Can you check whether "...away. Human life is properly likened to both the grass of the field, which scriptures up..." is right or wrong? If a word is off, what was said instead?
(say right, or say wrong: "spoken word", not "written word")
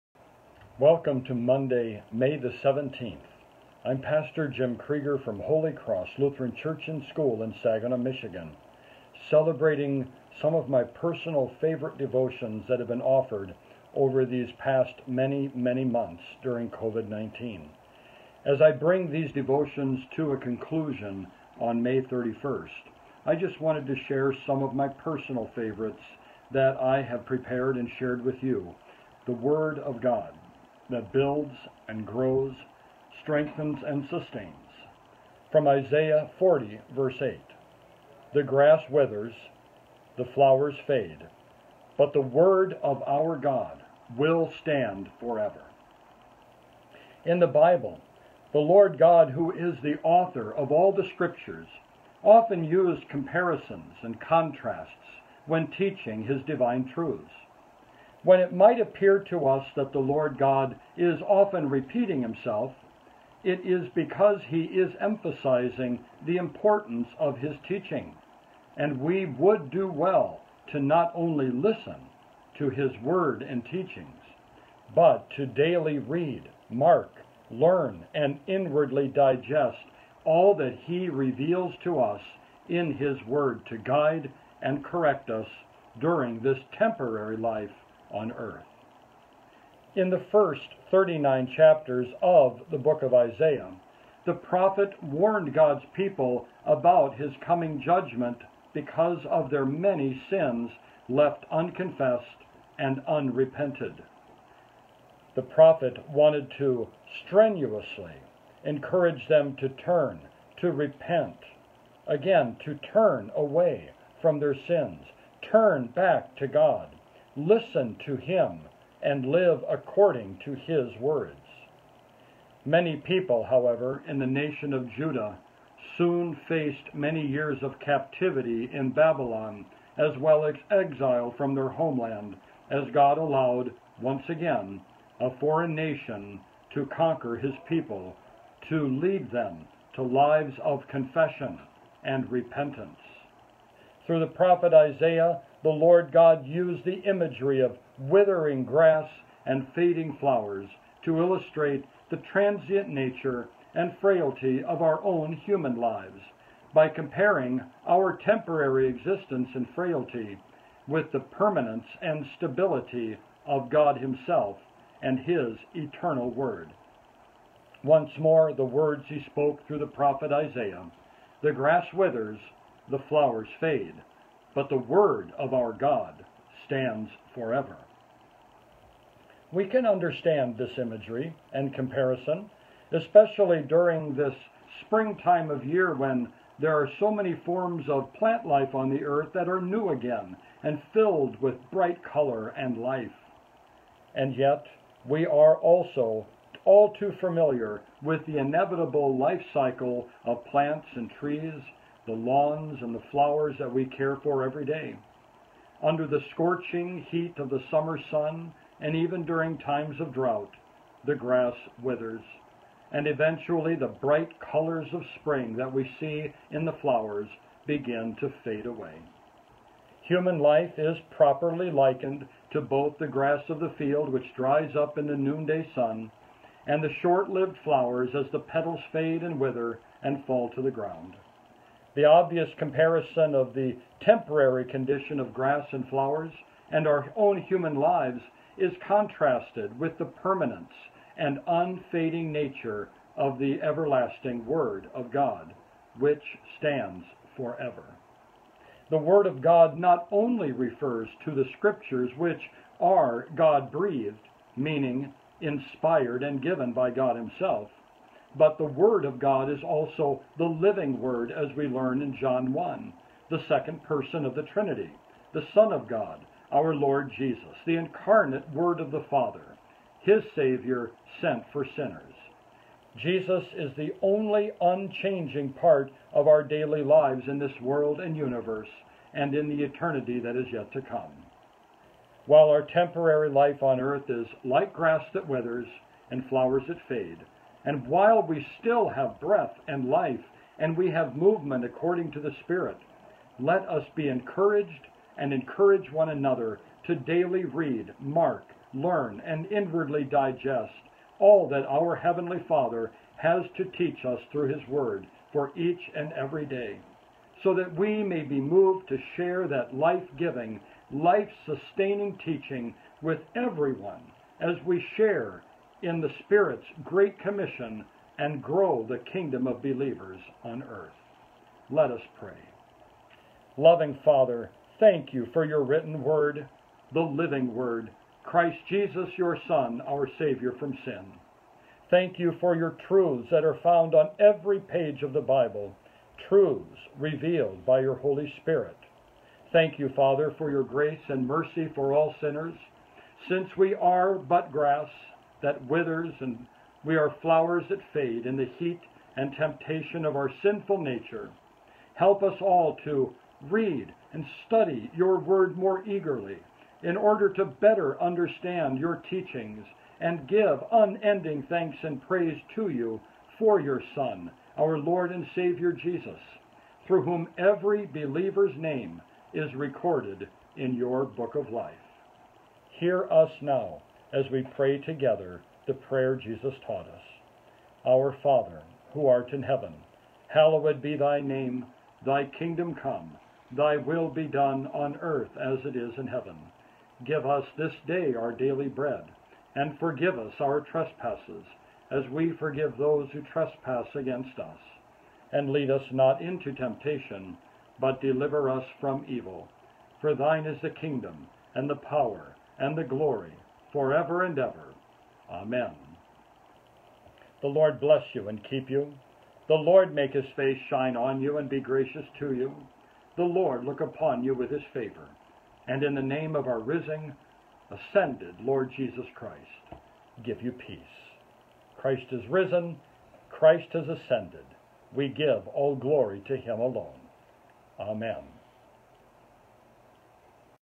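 wrong: "dries", not "scriptures".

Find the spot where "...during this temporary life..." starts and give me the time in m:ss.
1:25.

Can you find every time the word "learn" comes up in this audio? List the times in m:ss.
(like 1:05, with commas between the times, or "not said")
1:17, 4:21, 4:58.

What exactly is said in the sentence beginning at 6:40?
For thine is the kingdom, and the power, and the glory, forever and ever.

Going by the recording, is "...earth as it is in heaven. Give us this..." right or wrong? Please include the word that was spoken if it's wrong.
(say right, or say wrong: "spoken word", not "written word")
right.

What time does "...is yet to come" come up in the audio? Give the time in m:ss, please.
4:40.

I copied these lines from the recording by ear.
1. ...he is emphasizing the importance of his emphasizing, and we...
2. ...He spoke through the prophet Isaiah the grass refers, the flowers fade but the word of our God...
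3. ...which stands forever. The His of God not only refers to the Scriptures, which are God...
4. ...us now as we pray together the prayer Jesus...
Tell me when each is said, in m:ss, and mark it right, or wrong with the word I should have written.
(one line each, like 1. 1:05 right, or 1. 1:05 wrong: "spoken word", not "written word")
1. 1:04 wrong: "teaching", not "emphasizing"
2. 2:49 wrong: "withers", not "refers"
3. 4:05 wrong: "Word", not "His"
4. 6:13 right.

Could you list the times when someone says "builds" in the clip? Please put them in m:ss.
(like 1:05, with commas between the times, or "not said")
0:31.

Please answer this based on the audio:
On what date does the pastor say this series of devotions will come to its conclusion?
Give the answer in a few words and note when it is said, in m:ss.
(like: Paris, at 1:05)
May 31st, at 0:21.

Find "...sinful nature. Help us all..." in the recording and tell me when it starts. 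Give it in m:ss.
5:50.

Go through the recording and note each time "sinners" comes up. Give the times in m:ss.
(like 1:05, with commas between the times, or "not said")
4:31, 5:42.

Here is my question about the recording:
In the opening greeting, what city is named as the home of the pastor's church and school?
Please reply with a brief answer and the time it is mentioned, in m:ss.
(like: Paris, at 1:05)
Saginaw, Michigan, at 0:07.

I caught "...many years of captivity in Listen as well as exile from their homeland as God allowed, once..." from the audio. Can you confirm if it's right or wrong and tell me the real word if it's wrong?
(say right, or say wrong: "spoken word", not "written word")
wrong: "Babylon", not "Listen".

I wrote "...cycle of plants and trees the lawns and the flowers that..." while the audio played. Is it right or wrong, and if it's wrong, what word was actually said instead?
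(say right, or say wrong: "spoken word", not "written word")
right.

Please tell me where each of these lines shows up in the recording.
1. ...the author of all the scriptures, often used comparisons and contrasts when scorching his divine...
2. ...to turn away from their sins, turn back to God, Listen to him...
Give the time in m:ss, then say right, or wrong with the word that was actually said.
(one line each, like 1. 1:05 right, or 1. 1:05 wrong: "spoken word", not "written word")
1. 0:49 wrong: "teaching", not "scorching"
2. 1:52 right.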